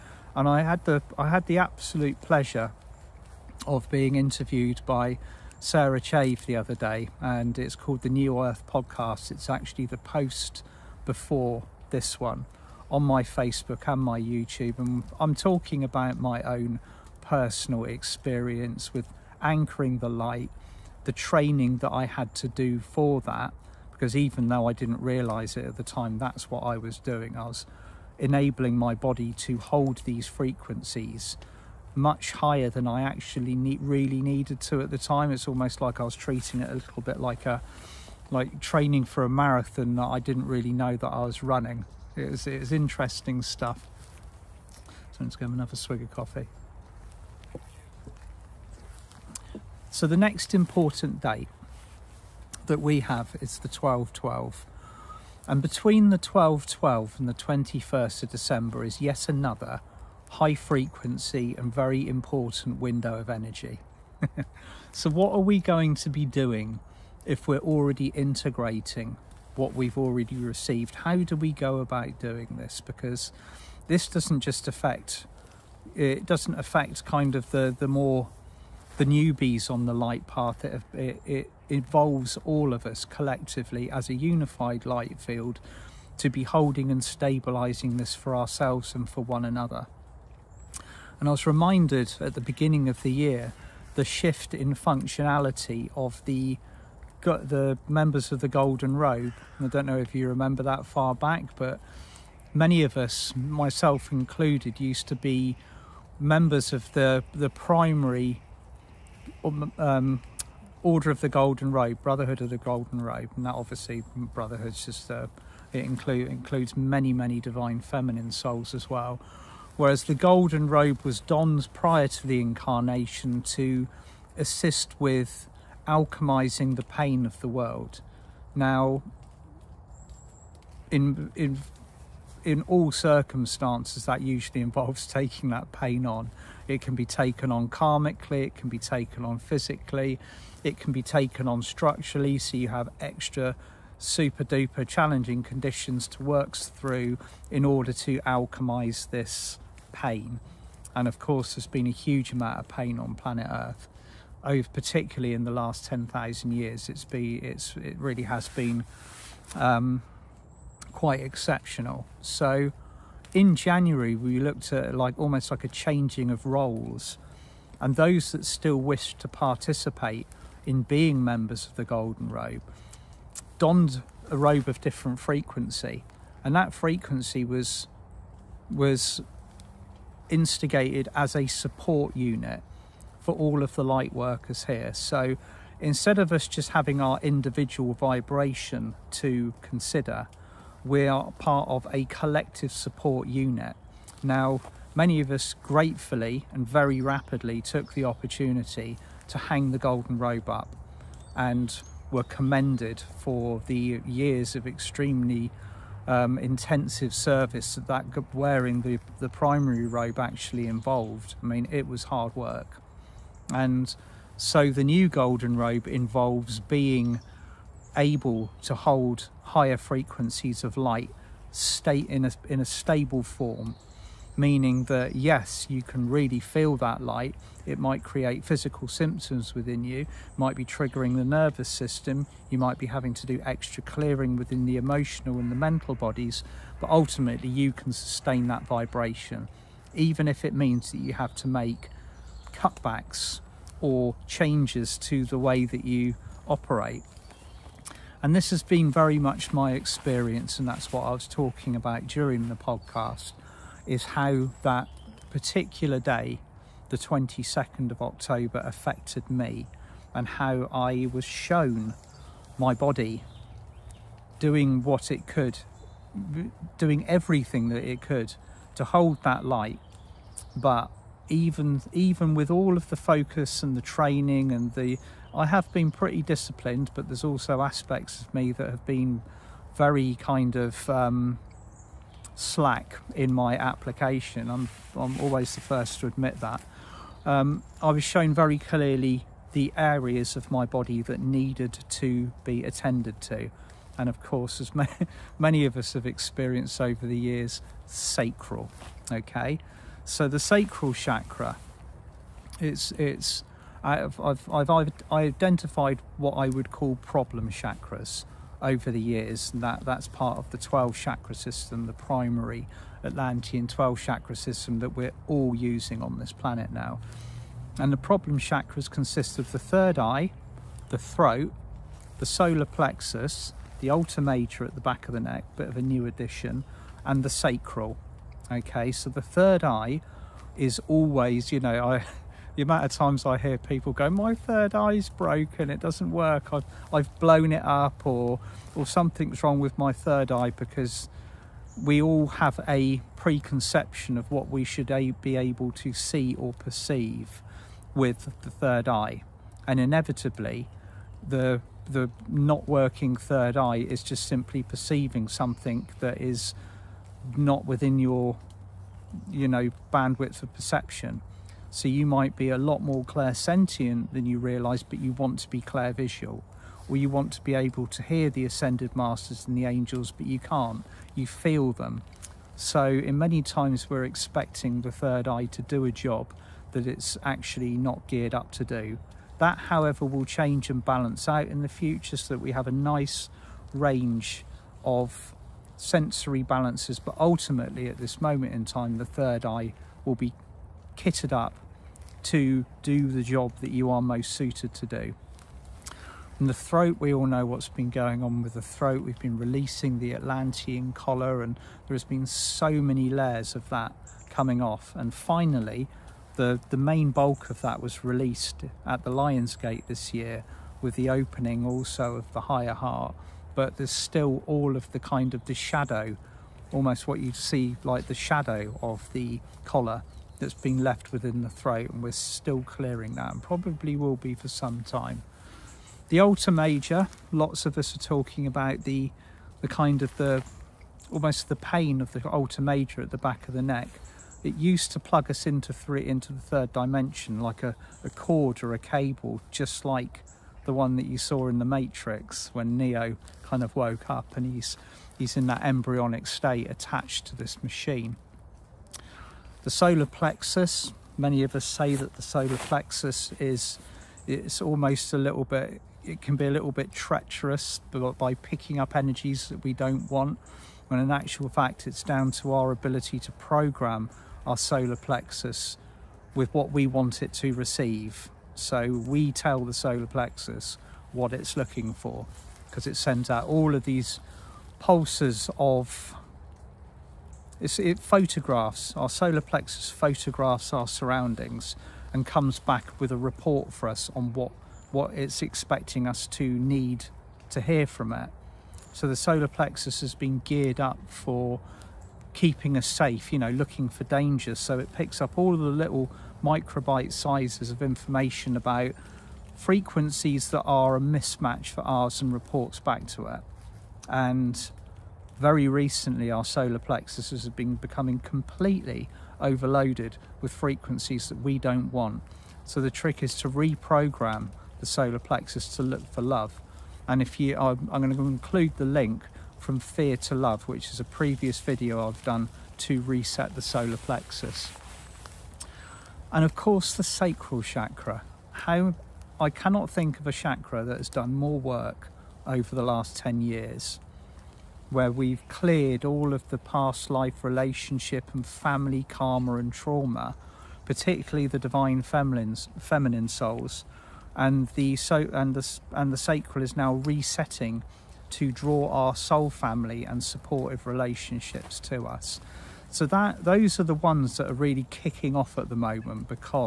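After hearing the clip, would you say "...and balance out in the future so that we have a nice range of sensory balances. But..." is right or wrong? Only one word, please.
right.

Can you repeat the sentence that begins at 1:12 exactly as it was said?
Because this doesn't just affect, it doesn't affect kind of the, the more, the newbies on the light path.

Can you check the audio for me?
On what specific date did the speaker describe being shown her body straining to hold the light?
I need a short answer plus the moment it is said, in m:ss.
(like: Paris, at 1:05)
22nd of October, at 4:16.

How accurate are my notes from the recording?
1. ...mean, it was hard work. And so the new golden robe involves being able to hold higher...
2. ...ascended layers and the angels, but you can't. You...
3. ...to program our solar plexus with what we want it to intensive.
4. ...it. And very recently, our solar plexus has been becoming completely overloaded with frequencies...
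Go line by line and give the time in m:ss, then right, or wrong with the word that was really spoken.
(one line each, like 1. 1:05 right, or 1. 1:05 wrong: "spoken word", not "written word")
1. 3:31 right
2. 6:08 wrong: "masters", not "layers"
3. 7:43 wrong: "receive", not "intensive"
4. 8:23 right.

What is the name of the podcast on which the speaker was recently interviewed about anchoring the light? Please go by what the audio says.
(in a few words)
New Earth Podcast.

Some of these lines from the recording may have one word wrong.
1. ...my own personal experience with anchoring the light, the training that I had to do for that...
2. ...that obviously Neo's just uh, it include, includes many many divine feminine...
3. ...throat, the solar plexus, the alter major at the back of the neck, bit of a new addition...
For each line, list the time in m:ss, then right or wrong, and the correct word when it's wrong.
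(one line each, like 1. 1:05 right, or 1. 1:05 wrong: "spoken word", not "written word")
1. 0:16 right
2. 1:53 wrong: "Brotherhood", not "Neo"
3. 5:20 right.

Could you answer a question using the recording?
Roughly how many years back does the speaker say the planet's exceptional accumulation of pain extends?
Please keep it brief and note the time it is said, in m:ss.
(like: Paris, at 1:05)
10,000, at 2:35.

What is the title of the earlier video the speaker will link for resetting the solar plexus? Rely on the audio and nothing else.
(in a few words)
From Fear to Love.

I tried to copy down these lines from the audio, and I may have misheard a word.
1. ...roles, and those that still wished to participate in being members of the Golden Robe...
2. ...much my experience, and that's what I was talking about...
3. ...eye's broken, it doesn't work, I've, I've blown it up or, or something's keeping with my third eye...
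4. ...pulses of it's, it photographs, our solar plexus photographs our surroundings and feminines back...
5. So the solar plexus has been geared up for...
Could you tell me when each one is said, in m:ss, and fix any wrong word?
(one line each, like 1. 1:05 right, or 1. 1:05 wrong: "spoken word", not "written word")
1. 2:46 right
2. 4:09 right
3. 5:34 wrong: "wrong", not "keeping"
4. 7:54 wrong: "comes", not "feminines"
5. 8:08 right.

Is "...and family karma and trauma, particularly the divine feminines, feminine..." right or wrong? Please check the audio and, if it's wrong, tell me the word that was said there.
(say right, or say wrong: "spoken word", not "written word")
right.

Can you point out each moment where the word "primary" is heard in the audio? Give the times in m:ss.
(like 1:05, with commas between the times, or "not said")
1:47, 3:29, 5:11.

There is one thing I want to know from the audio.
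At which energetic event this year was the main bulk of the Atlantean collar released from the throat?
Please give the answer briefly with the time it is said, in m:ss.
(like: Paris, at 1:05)
Lion's Gate, at 6:49.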